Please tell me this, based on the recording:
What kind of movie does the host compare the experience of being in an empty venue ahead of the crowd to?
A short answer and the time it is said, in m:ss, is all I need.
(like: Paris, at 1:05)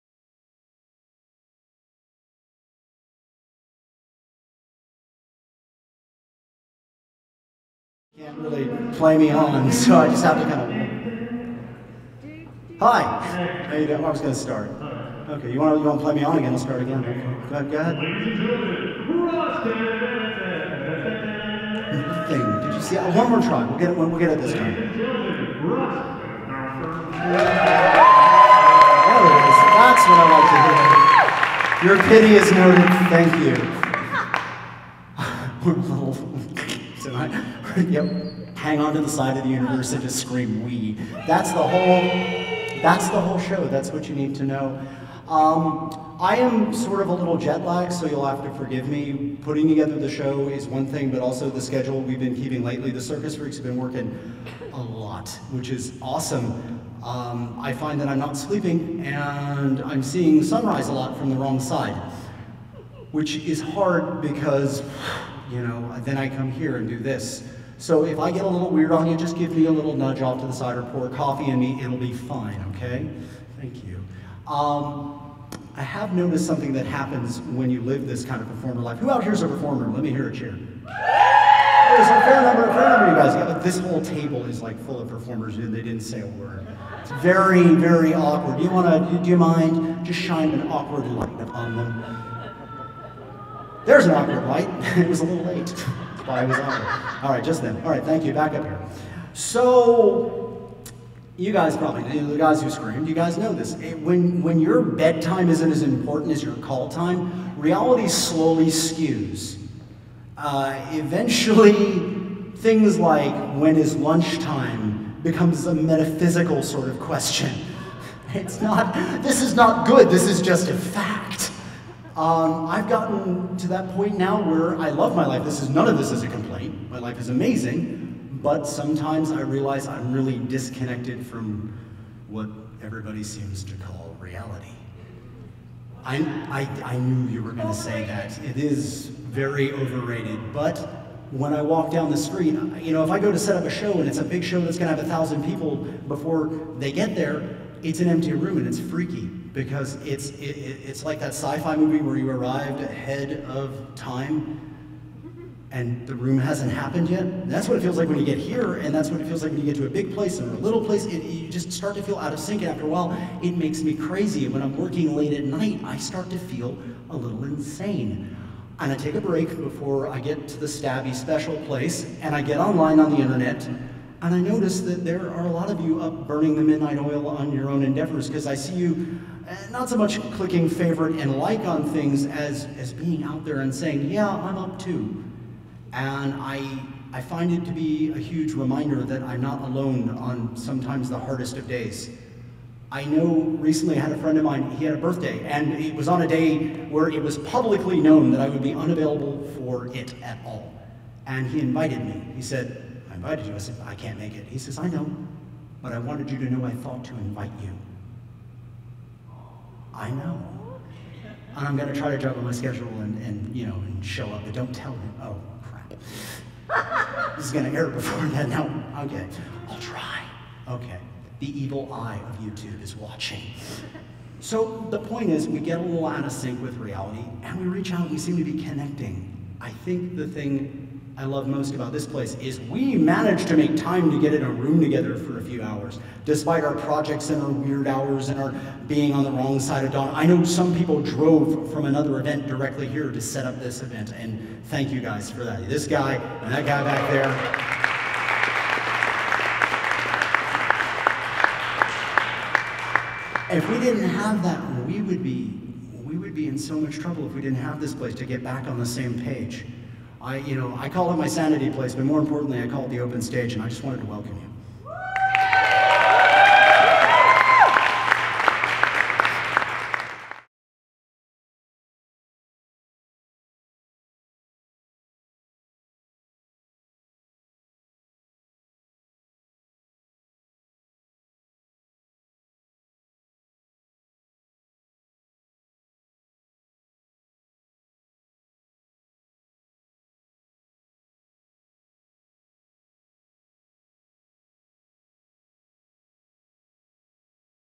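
sci-fi movie, at 2:31.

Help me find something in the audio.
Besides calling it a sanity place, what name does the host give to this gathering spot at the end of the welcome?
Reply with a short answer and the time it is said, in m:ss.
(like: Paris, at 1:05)
the open stage, at 4:22.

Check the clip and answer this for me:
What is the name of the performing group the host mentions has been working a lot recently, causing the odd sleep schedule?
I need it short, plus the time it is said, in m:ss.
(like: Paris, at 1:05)
The Circus Freaks, at 0:52.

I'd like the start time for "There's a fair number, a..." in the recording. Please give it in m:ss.
1:20.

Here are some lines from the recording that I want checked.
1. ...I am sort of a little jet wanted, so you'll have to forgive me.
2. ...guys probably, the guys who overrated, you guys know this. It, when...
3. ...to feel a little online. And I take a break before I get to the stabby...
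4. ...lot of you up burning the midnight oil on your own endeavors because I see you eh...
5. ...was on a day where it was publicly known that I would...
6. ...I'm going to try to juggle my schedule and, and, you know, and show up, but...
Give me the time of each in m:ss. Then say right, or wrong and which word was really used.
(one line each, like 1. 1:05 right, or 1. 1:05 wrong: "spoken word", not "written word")
1. 0:46 wrong: "lagged", not "wanted"
2. 1:41 wrong: "screamed", not "overrated"
3. 2:46 wrong: "insane", not "online"
4. 2:55 right
5. 3:15 right
6. 3:31 right.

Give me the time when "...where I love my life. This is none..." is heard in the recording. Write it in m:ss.
2:04.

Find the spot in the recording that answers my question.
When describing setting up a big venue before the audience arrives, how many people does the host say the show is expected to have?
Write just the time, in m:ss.
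2:25.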